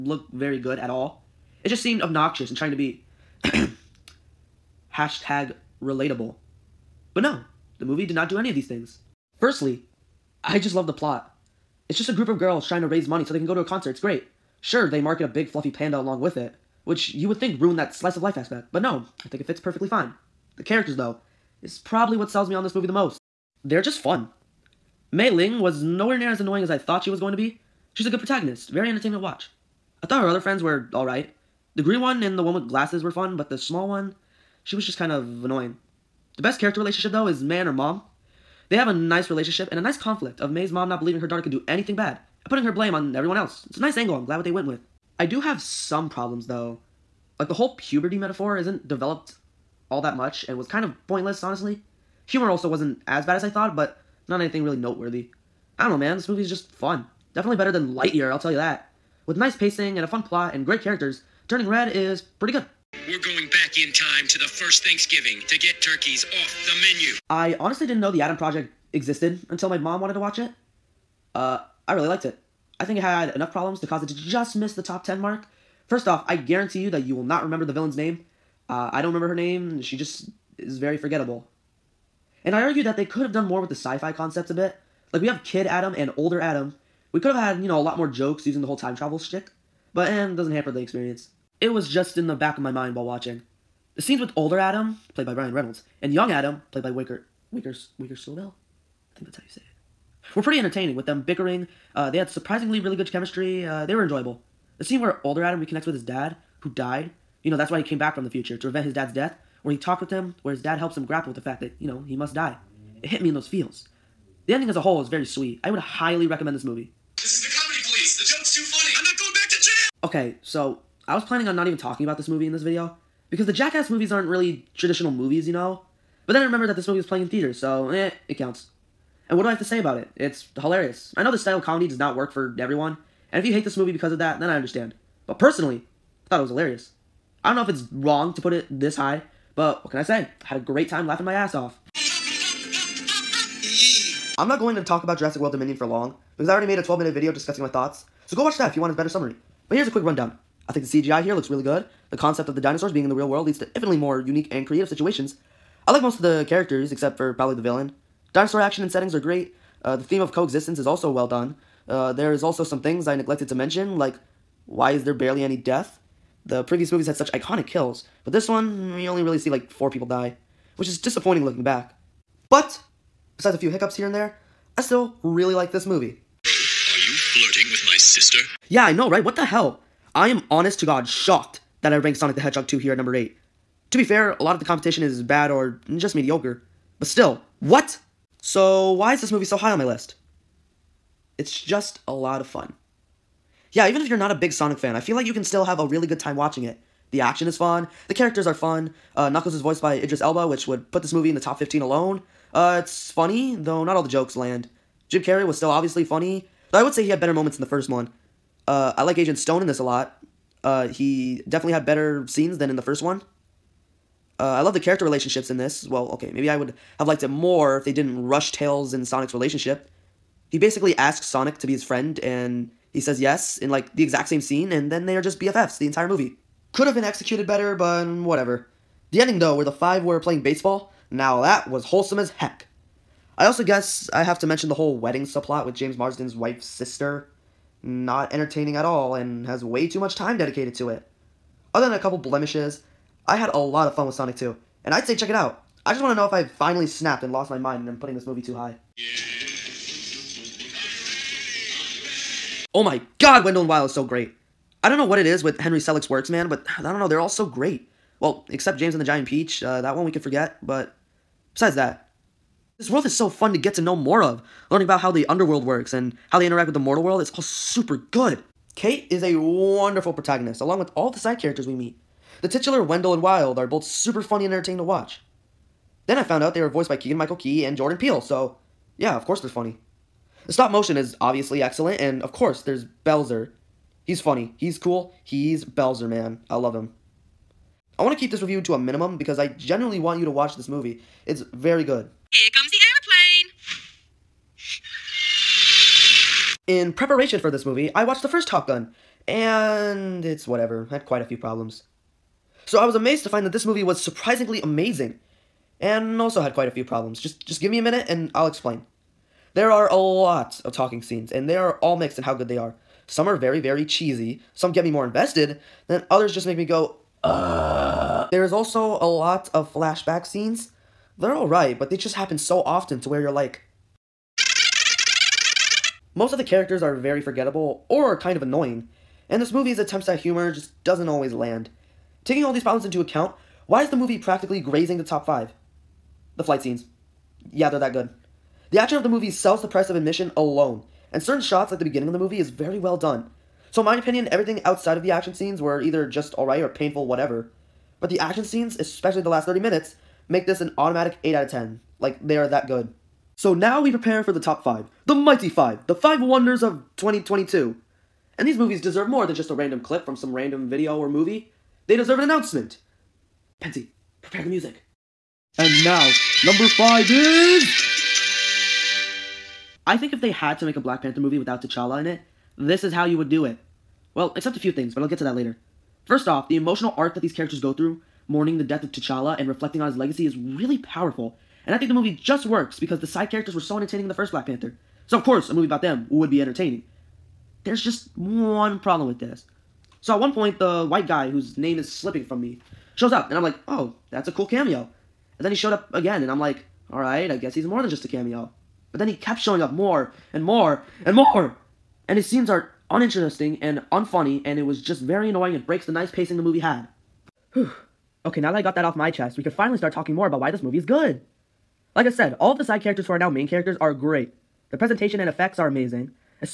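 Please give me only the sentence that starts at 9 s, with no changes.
Firstly, I just love the plot.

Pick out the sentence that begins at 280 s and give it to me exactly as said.
The stop motion is obviously excellent, and of course there's Belzer, He's funny.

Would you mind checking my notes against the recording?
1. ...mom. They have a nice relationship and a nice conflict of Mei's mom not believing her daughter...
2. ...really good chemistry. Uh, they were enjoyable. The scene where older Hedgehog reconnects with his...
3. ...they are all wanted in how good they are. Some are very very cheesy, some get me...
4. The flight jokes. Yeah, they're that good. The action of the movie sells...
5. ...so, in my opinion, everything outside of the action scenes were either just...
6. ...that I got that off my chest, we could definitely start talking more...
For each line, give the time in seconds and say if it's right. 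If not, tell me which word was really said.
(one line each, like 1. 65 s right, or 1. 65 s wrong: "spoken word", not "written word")
1. 37 s right
2. 102 s wrong: "Adam", not "Hedgehog"
3. 311 s wrong: "mixed", not "wanted"
4. 336 s wrong: "scenes", not "jokes"
5. 343 s right
6. 408 s wrong: "finally", not "definitely".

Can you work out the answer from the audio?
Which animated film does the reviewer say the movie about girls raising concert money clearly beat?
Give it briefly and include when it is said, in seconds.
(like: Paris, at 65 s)
Lightyear, at 57 s.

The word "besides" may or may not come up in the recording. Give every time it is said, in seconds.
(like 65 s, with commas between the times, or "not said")
173 s, 261 s.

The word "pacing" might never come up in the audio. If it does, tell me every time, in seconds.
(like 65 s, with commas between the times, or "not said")
59 s, 406 s.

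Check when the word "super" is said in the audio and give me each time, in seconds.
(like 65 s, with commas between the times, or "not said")
267 s, 273 s.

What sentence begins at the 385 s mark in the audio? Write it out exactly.
So of course, a movie about them would be entertaining.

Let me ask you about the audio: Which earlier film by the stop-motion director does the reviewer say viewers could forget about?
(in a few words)
James and the Giant Peach.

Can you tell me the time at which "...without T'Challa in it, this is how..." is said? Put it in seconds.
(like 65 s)
371 s.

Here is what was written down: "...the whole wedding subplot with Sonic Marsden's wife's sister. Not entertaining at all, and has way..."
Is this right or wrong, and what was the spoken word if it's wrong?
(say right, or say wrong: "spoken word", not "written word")
wrong: "James", not "Sonic".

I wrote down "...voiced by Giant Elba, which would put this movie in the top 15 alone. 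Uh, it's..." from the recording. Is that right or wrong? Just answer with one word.
wrong.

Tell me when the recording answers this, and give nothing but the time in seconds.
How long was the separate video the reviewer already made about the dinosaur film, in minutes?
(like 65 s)
146 s.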